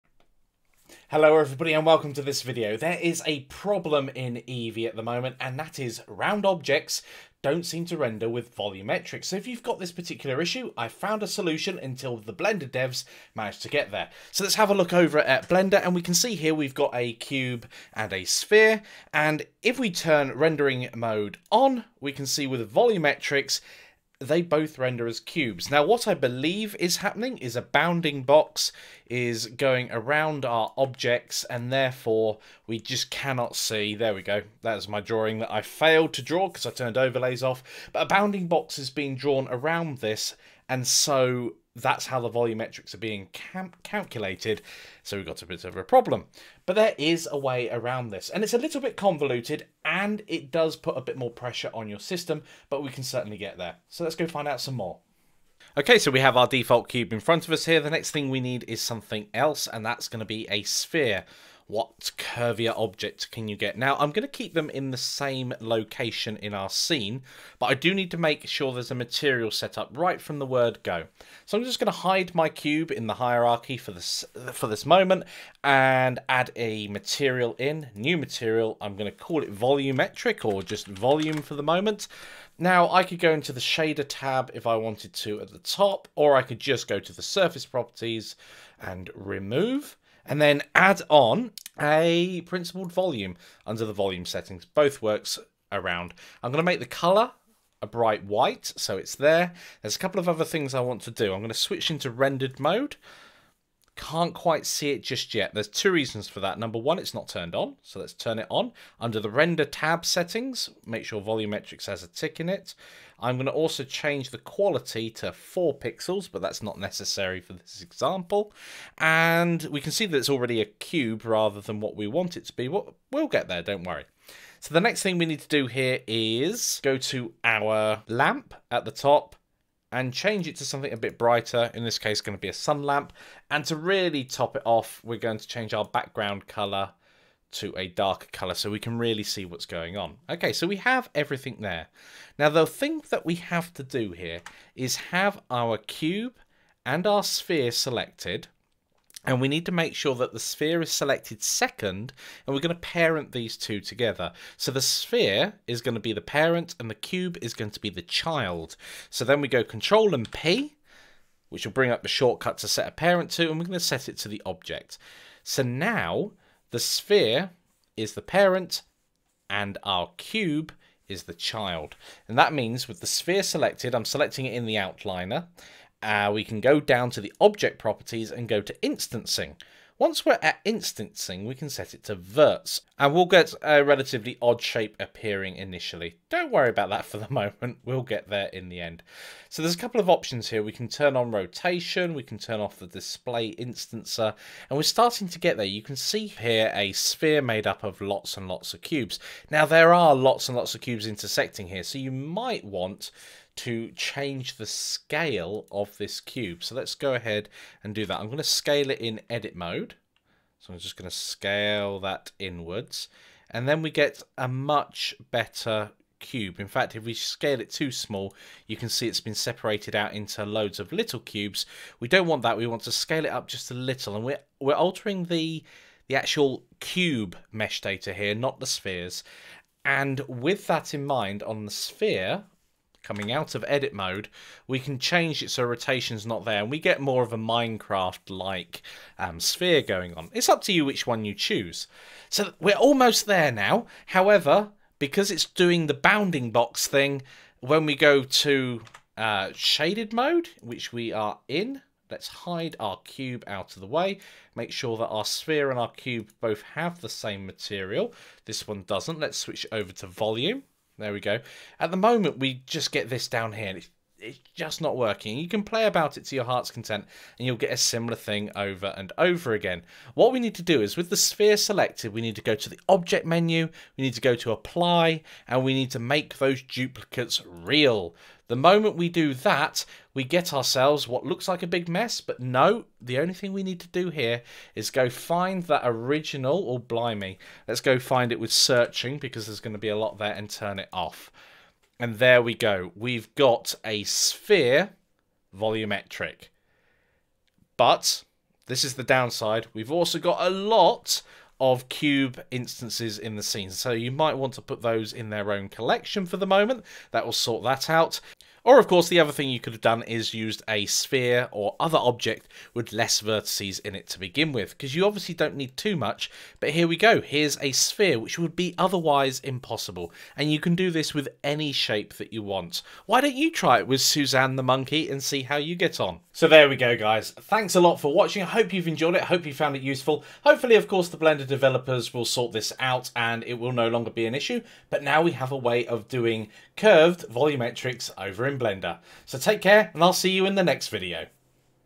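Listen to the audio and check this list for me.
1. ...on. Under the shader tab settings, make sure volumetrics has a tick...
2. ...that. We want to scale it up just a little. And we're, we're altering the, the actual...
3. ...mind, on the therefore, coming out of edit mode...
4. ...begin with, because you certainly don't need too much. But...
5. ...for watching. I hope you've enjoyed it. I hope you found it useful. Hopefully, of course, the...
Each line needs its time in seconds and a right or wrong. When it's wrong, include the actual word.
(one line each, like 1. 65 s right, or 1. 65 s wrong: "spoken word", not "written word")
1. 108 s wrong: "render", not "shader"
2. 222 s right
3. 231 s wrong: "sphere", not "therefore"
4. 314 s wrong: "obviously", not "certainly"
5. 327 s right.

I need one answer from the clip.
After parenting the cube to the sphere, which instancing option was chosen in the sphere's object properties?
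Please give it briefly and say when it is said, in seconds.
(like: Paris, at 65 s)
verts, at 182 s.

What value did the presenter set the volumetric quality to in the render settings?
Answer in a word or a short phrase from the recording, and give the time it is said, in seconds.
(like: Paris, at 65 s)
4 pixels, at 115 s.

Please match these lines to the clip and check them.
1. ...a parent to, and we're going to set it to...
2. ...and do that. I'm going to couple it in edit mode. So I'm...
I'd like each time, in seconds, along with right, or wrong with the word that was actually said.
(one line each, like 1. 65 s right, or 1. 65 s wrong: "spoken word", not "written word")
1. 162 s right
2. 207 s wrong: "scale", not "couple".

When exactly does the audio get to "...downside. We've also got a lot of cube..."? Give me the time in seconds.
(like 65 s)
299 s.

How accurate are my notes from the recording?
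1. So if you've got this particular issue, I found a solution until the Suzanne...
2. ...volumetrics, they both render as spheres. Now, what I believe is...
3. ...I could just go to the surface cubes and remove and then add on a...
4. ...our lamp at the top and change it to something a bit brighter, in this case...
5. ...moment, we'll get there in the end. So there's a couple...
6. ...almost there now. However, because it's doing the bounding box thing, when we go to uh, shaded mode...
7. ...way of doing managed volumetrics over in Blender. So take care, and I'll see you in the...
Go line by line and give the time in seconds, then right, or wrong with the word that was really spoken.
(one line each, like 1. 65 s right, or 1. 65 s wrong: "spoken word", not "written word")
1. 9 s wrong: "Blender", not "Suzanne"
2. 22 s wrong: "cubes", not "spheres"
3. 86 s wrong: "properties", not "cubes"
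4. 127 s right
5. 187 s right
6. 242 s right
7. 335 s wrong: "curved", not "managed".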